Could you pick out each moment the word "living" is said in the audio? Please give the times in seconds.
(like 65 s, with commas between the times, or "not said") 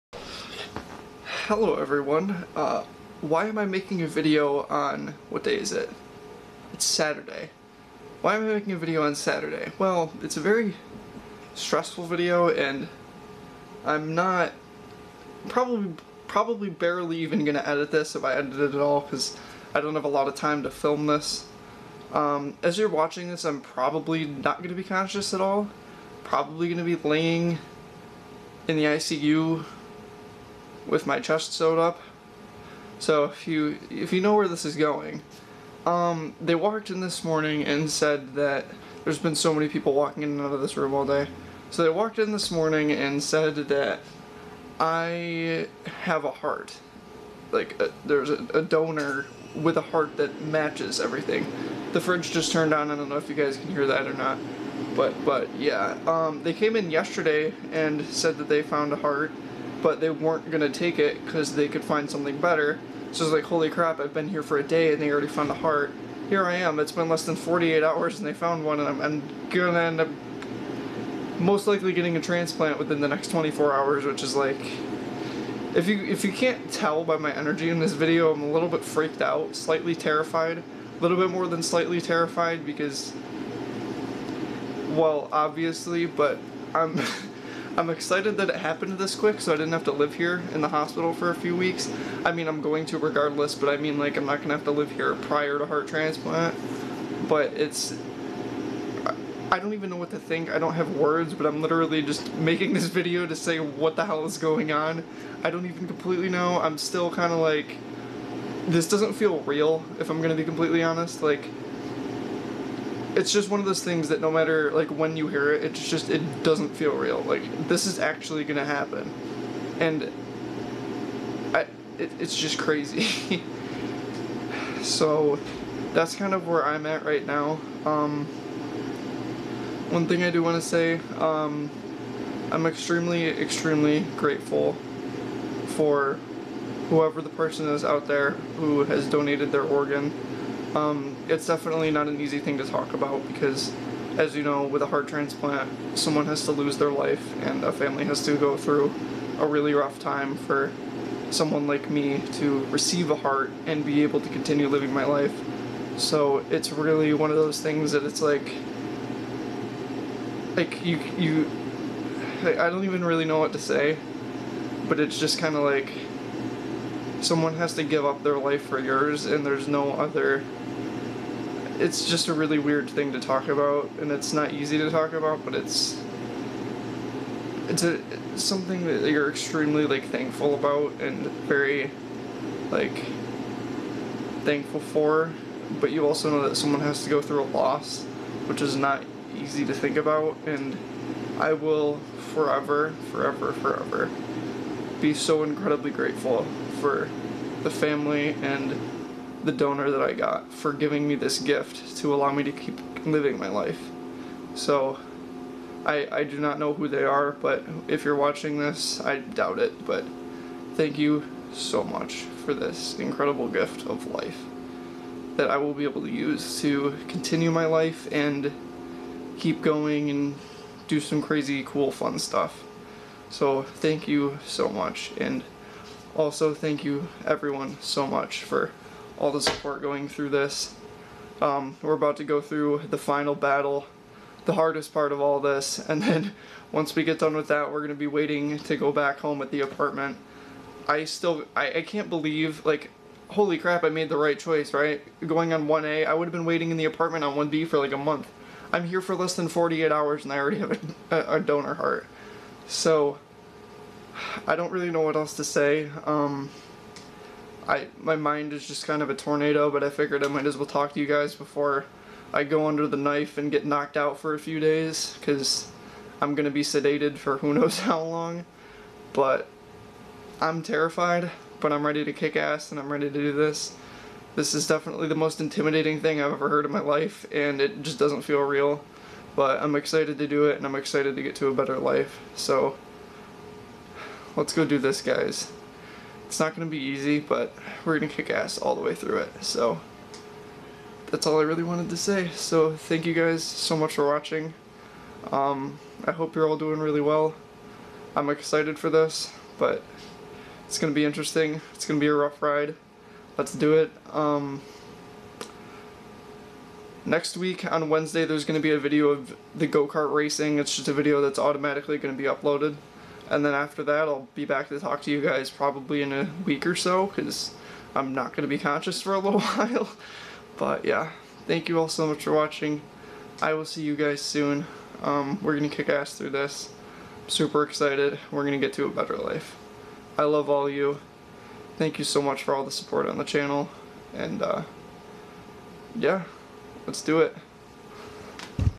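154 s, 203 s.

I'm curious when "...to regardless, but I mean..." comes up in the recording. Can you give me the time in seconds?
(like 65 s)
92 s.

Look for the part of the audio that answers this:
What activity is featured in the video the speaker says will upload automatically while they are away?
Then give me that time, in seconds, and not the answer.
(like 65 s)
309 s.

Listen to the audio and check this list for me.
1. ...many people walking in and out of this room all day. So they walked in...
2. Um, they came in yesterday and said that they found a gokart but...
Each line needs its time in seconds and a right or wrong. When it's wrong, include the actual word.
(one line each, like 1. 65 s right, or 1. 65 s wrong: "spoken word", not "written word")
1. 39 s right
2. 56 s wrong: "heart", not "gokart".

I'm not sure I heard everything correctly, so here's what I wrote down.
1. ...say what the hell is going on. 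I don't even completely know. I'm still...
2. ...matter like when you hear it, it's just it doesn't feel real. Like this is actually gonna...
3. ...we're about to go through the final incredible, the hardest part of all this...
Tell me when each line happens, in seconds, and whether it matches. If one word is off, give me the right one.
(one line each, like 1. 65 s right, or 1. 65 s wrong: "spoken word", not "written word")
1. 103 s right
2. 114 s right
3. 231 s wrong: "battle", not "incredible".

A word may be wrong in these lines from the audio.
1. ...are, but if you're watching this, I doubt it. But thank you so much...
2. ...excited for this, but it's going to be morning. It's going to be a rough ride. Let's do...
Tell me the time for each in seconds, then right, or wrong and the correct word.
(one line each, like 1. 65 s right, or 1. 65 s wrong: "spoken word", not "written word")
1. 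207 s right
2. 298 s wrong: "interesting", not "morning".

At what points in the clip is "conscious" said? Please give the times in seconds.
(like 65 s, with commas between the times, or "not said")
24 s, 318 s.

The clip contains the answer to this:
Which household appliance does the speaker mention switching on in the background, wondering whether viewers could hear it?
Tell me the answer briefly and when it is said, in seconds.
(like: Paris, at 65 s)
Fridge, at 51 s.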